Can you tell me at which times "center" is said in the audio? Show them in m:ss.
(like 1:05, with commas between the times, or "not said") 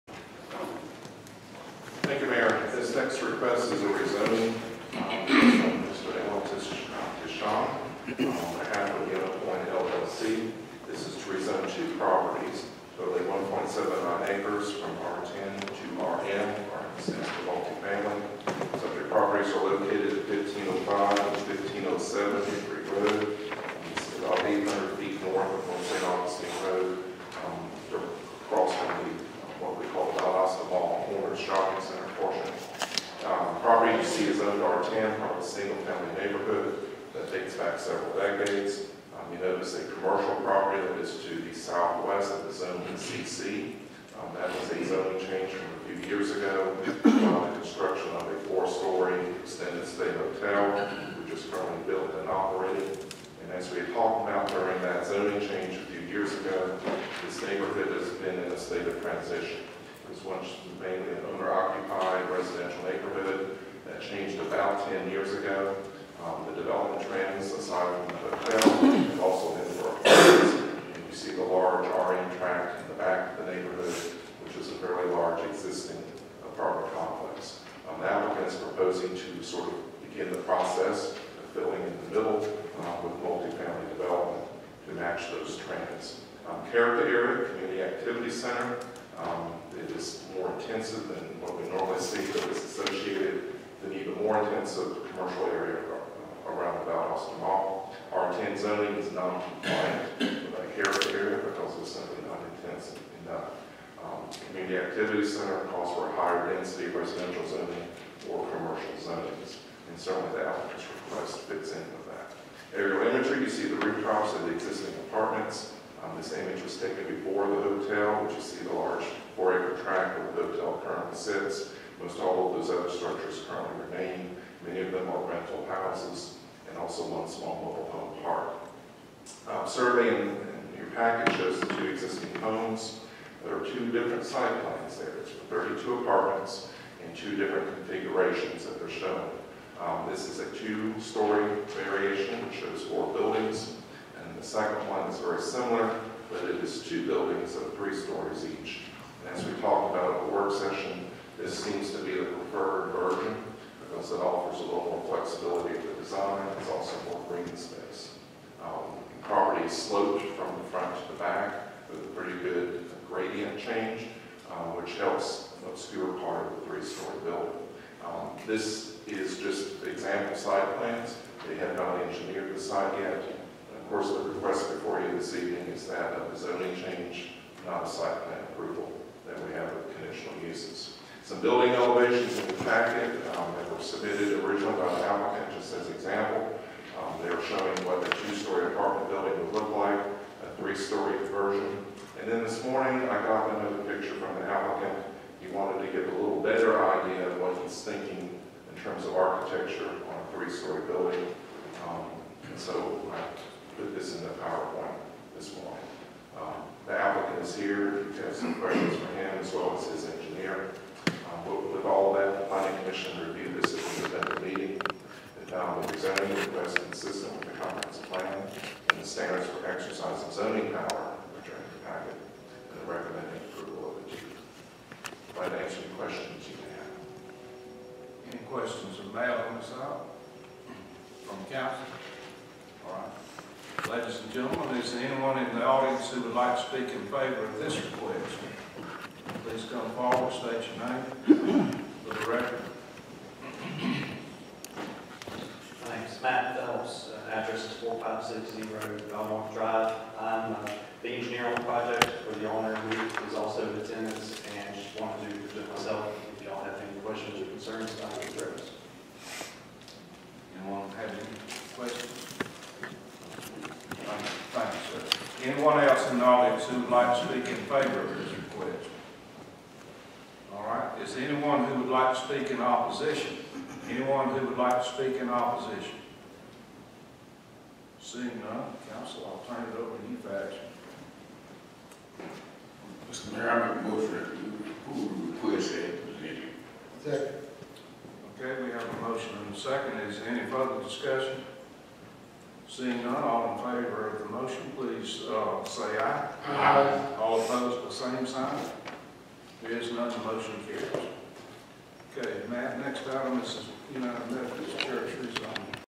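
1:28, 1:45.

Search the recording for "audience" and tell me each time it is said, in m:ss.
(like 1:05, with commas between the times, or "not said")
3:55, 4:26.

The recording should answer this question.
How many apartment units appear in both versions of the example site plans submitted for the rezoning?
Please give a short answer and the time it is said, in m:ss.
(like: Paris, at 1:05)
32, at 2:15.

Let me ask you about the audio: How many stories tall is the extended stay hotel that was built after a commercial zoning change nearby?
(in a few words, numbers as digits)
four.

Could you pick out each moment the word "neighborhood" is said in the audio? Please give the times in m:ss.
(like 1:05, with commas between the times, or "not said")
0:36, 0:57, 1:02, 1:13.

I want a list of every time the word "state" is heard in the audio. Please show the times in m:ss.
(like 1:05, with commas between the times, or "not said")
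0:58, 4:00.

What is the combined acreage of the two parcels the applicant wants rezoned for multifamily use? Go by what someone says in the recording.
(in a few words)
1.79 acres.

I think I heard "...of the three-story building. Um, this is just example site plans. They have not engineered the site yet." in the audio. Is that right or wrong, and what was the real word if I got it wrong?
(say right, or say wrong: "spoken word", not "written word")
right.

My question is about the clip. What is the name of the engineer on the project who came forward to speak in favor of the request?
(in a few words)
Matt Phelps.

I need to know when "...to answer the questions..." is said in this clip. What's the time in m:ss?
3:45.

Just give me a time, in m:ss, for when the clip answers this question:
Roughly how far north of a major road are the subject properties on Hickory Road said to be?
0:24.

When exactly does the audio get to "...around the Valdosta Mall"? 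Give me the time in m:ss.
1:36.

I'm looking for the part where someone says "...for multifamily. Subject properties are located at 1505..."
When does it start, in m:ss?
0:17.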